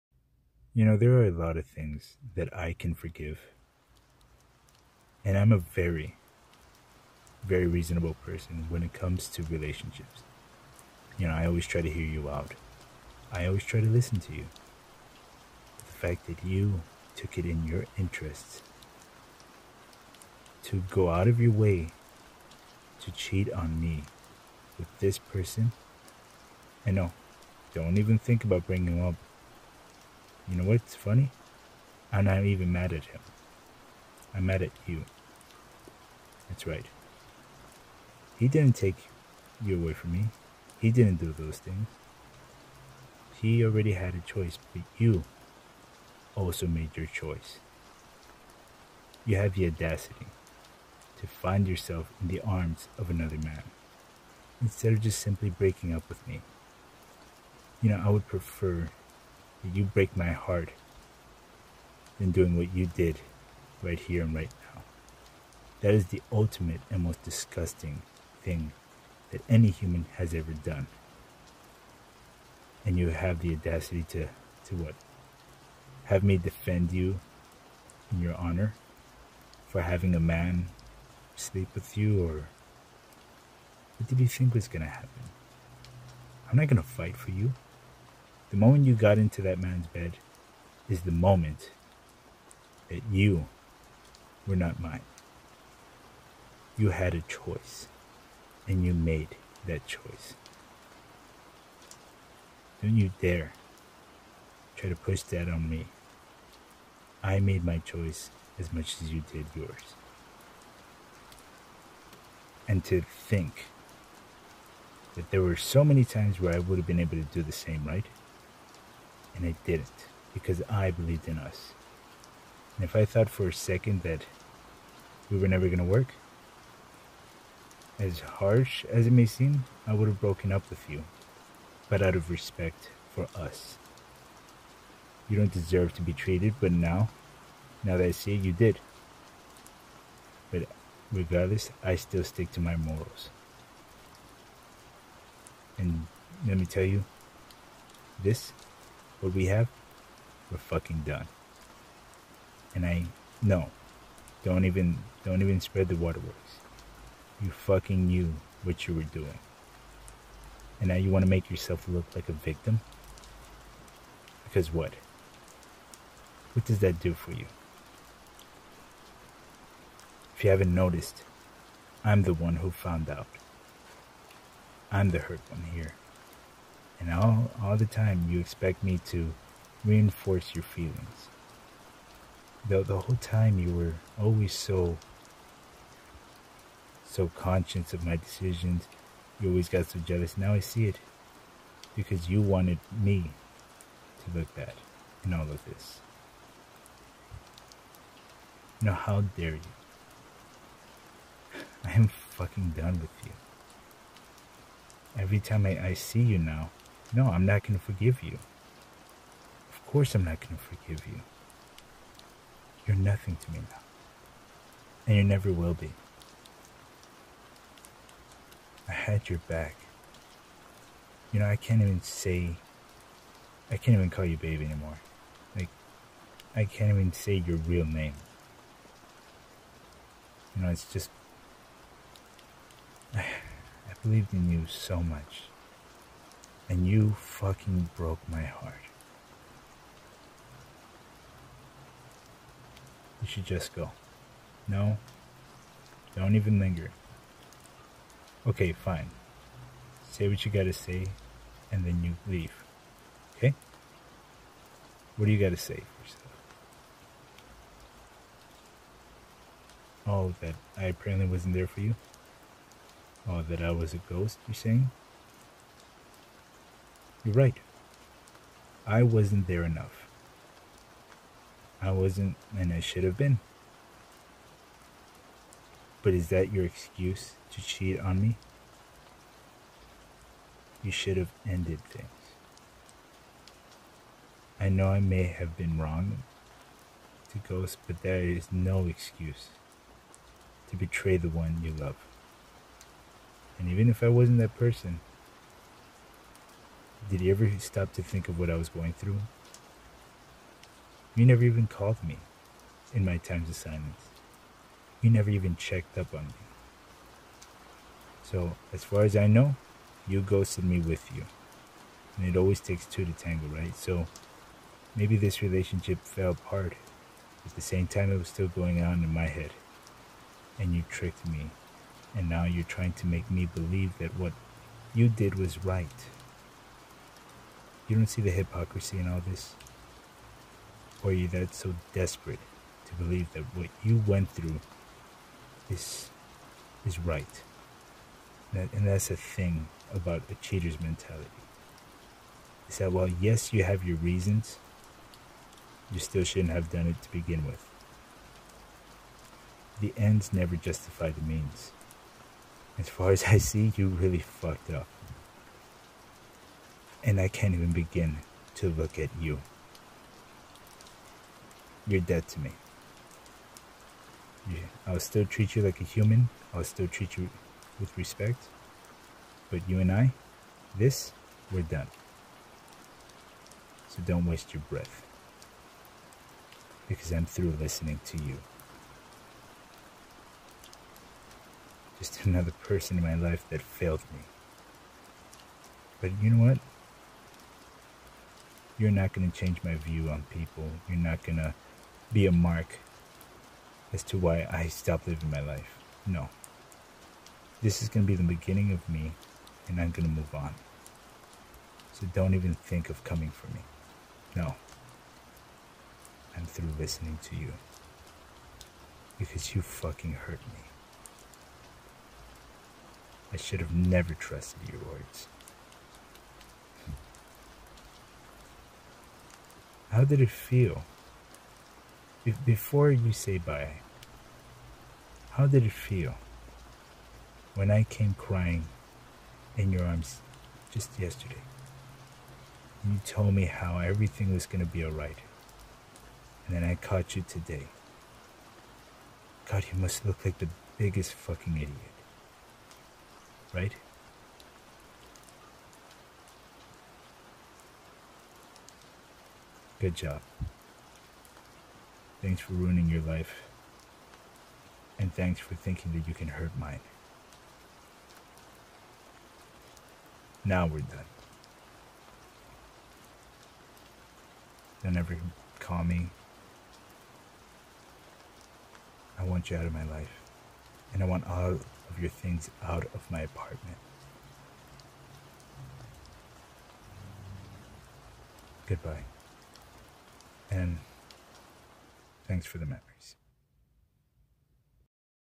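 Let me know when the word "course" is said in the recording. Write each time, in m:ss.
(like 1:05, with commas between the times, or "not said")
3:29.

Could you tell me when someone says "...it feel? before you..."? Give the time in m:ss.
7:00.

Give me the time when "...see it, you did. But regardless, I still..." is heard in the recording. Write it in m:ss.
2:18.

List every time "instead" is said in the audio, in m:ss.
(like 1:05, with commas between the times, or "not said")
0:54.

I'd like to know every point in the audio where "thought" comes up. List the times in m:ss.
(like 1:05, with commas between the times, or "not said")
2:03.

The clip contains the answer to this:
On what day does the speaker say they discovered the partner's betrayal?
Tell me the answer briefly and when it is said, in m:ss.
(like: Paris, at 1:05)
today, at 7:17.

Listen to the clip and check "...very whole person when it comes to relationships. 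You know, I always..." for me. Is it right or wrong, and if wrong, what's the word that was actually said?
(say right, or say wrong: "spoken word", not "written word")
wrong: "reasonable", not "whole".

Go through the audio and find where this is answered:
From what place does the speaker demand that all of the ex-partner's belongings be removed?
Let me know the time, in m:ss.
7:53.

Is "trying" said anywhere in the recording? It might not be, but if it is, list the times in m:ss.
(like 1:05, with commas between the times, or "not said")
5:22.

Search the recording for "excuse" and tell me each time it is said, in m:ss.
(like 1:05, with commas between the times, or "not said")
4:36, 4:48.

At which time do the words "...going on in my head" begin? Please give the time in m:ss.
5:18.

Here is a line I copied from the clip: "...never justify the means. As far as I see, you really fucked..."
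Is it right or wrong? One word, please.
right.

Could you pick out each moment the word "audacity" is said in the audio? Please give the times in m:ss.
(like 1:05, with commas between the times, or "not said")
0:49, 1:13.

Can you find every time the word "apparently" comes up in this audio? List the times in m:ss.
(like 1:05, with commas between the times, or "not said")
4:20.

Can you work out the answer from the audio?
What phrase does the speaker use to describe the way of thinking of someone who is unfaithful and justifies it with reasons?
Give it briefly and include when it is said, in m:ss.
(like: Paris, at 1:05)
cheater's mentality, at 5:40.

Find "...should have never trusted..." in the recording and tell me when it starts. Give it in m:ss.
6:53.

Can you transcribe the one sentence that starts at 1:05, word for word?
That is the ultimate and most disgusting thing that any human has ever done.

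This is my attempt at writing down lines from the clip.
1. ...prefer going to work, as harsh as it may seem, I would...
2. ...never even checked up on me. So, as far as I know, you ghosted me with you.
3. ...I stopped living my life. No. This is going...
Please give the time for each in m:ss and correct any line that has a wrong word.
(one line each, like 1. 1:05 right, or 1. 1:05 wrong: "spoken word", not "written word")
1. 2:05 wrong: "never", not "prefer"
2. 5:05 right
3. 6:34 right.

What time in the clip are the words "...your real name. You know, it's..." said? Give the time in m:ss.
3:47.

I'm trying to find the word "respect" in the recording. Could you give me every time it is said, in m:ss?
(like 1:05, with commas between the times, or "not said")
2:12, 6:07.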